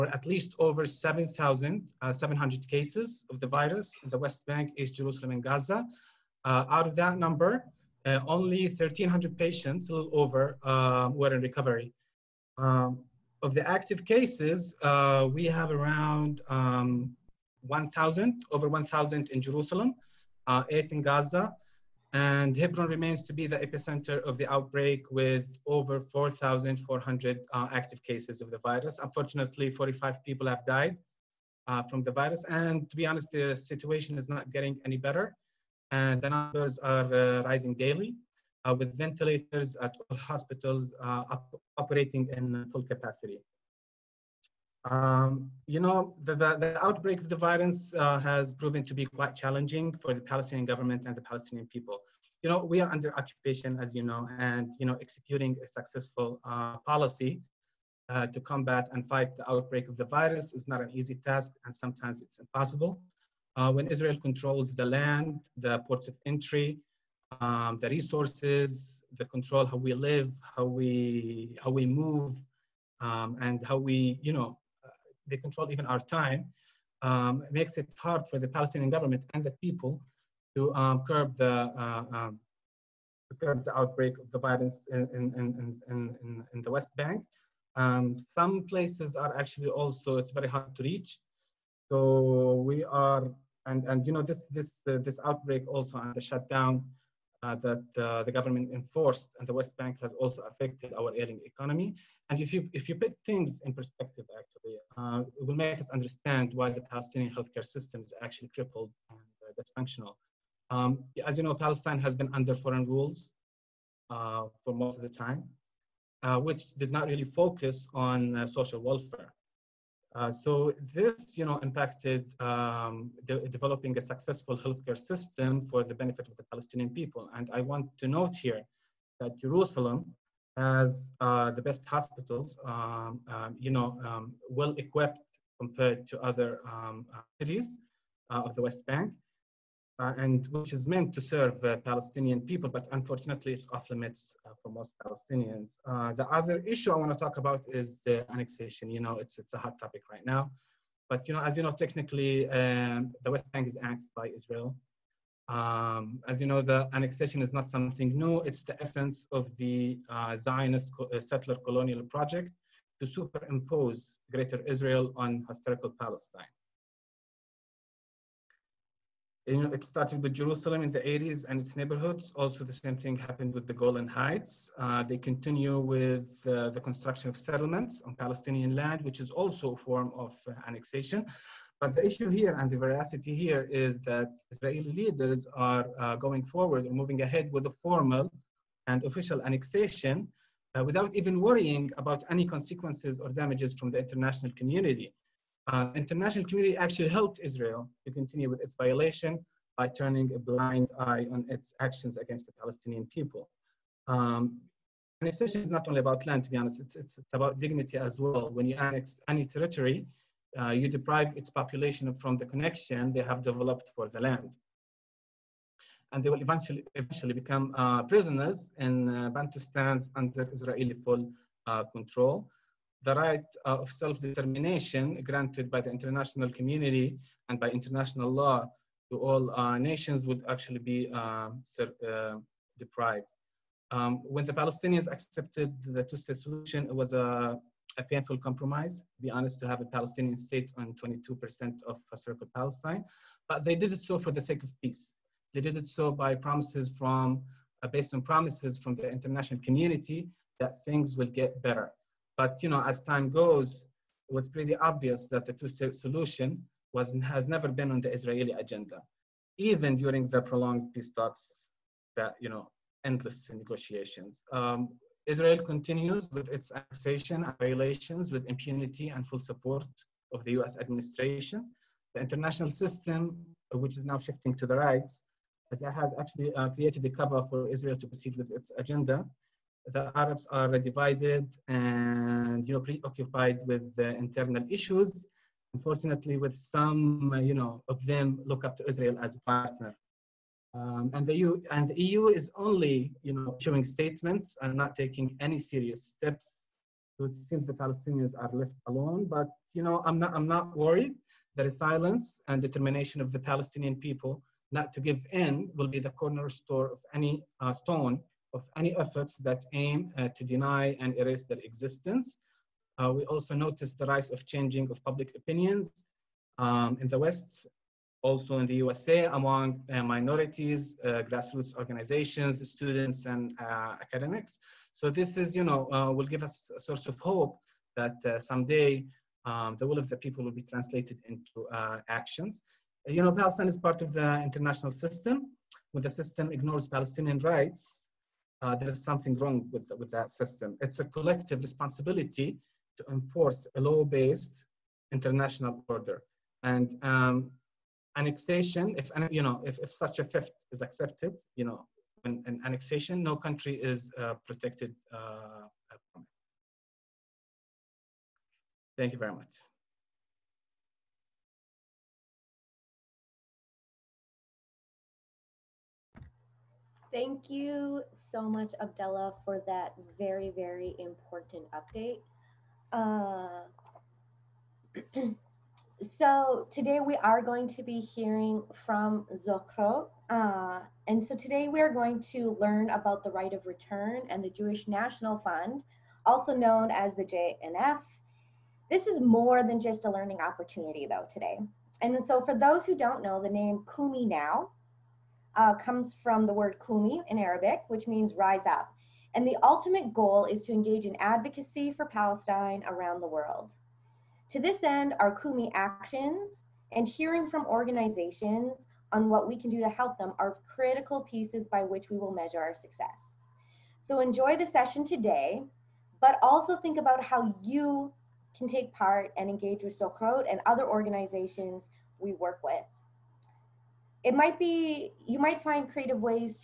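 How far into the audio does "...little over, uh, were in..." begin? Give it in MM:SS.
00:09.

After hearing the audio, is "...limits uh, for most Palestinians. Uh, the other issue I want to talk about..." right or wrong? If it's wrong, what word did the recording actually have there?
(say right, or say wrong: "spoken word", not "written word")
right.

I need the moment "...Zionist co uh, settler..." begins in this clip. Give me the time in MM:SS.
02:40.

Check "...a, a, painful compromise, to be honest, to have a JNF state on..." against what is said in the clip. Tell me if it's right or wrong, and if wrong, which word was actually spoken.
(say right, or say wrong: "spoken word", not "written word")
wrong: "Palestinian", not "JNF".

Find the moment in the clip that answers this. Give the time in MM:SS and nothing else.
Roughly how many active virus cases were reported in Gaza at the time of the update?
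00:20.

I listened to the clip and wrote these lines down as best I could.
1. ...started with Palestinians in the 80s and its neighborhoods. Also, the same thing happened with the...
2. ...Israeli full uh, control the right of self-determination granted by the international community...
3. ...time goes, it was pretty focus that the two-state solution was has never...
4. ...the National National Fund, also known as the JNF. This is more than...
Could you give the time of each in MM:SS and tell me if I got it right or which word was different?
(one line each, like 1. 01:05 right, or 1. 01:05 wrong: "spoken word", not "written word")
1. 02:49 wrong: "Jerusalem", not "Palestinians"
2. 03:40 right
3. 04:12 wrong: "obvious", not "focus"
4. 06:24 wrong: "Jewish", not "National".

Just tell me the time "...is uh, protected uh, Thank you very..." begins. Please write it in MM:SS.
05:53.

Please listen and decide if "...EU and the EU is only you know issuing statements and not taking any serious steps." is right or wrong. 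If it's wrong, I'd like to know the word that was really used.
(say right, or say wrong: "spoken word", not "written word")
right.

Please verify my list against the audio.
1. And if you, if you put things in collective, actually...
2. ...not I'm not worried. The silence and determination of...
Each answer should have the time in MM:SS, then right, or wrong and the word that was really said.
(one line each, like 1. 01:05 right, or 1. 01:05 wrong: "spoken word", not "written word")
1. 01:42 wrong: "perspective", not "collective"
2. 05:00 right.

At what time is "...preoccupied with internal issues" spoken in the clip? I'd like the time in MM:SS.
04:42.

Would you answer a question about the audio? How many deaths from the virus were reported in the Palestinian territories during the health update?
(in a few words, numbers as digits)
45.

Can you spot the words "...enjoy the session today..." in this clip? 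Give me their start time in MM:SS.
06:54.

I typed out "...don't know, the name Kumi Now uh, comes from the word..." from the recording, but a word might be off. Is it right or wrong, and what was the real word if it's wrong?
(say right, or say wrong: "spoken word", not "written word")
right.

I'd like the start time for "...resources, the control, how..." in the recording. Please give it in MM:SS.
01:07.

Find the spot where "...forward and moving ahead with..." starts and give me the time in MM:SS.
03:06.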